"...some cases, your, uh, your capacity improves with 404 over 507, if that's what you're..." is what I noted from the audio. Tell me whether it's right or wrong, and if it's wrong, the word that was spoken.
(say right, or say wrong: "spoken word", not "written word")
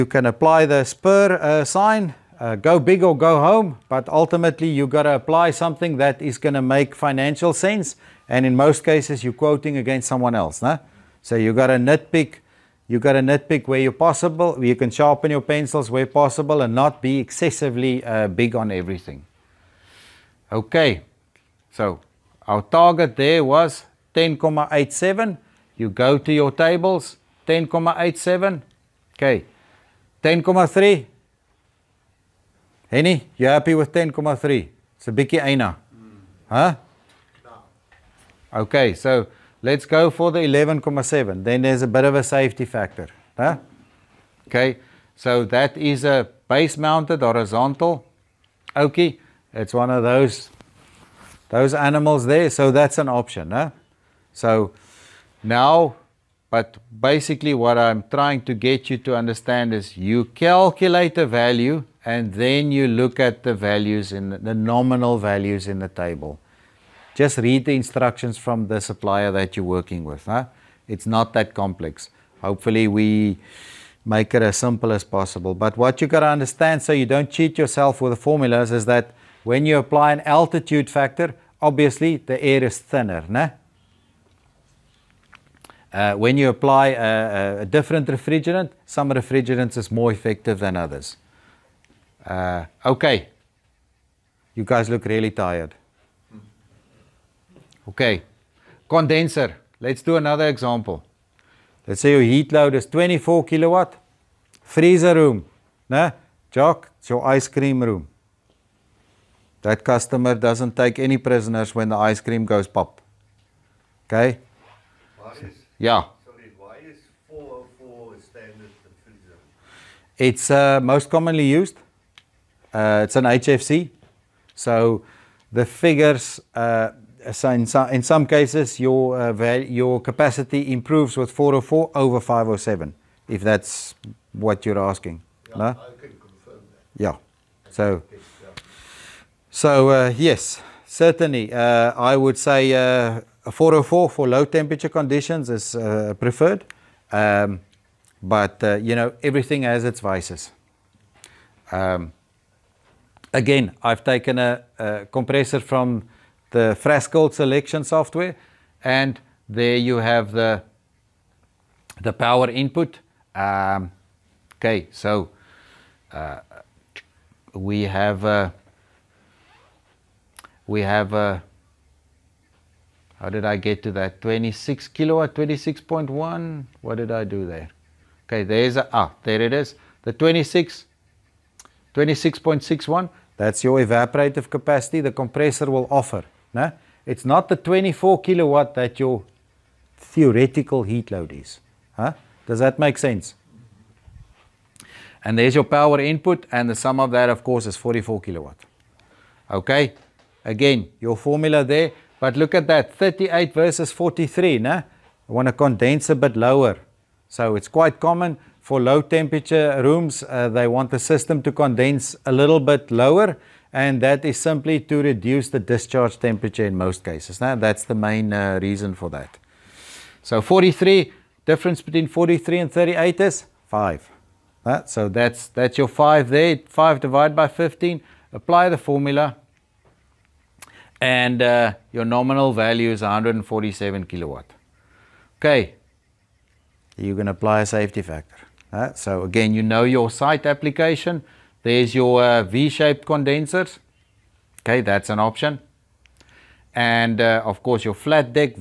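right.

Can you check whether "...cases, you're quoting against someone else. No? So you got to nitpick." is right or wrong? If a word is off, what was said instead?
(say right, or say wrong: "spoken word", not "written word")
right.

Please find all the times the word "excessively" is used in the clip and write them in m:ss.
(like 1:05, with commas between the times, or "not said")
0:17.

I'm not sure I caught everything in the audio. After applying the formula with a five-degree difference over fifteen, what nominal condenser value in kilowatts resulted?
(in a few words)
147 kilowatt.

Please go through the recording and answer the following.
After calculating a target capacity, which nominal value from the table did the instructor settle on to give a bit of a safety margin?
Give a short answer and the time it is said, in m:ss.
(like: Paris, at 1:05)
11.7, at 0:40.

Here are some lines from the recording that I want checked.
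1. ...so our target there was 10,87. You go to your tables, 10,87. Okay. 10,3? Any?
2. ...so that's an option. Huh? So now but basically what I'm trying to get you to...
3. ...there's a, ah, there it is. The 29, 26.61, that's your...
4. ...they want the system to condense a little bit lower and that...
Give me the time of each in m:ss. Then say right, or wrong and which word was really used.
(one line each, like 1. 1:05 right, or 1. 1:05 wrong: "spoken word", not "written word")
1. 0:21 right
2. 0:52 right
3. 2:58 wrong: "26", not "29"
4. 3:30 right.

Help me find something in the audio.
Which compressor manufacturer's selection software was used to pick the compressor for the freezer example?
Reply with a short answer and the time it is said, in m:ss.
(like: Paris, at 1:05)
Frascold, at 2:36.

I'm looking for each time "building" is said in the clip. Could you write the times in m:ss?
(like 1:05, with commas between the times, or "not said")
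not said.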